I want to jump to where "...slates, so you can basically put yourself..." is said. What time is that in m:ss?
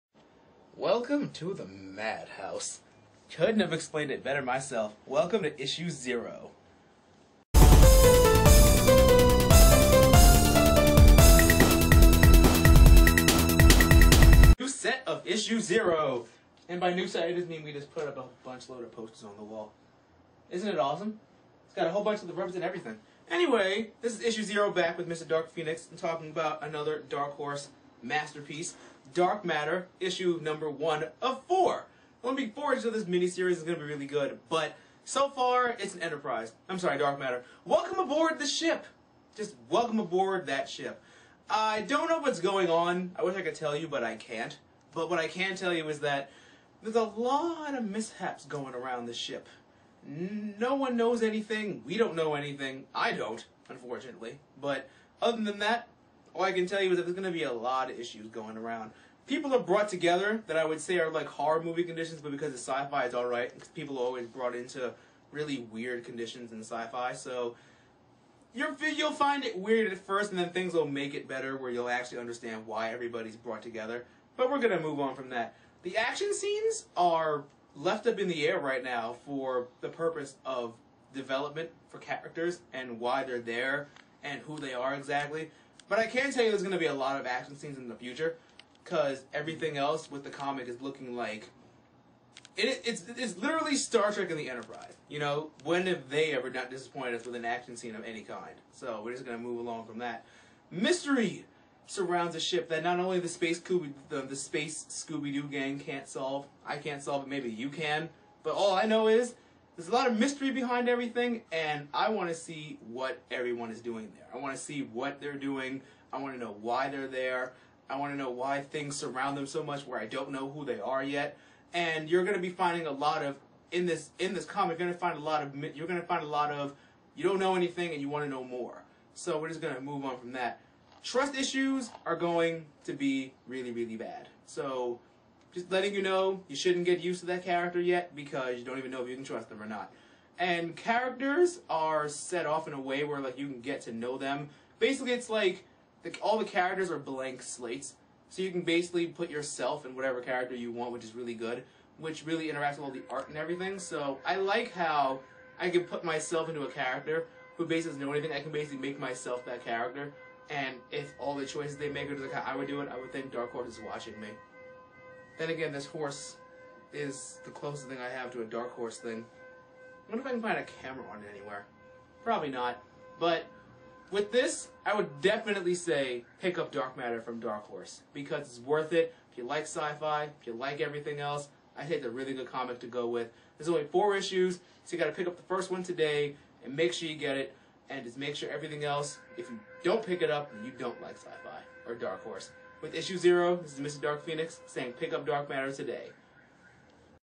2:27.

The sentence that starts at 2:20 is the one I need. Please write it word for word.
And characters are set off in a way where like you can get to know them.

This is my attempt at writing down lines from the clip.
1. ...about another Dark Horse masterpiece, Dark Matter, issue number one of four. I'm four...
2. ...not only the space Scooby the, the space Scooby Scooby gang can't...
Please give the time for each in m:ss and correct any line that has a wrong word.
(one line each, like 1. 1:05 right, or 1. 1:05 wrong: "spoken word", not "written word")
1. 0:26 right
2. 1:42 wrong: "Doo", not "Scooby".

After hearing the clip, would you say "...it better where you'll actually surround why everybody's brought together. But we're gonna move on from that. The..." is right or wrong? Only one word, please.
wrong.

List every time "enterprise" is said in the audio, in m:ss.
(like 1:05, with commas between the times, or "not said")
0:36, 1:34.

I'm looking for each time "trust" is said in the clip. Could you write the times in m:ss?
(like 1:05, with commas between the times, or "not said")
2:11, 2:19.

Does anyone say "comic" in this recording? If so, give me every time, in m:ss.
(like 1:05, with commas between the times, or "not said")
1:30, 2:04, 3:02.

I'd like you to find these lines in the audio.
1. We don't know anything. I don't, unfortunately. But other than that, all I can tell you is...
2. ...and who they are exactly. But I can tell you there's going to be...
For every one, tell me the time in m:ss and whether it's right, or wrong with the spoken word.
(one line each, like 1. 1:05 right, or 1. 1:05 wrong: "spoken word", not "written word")
1. 0:51 right
2. 1:24 right.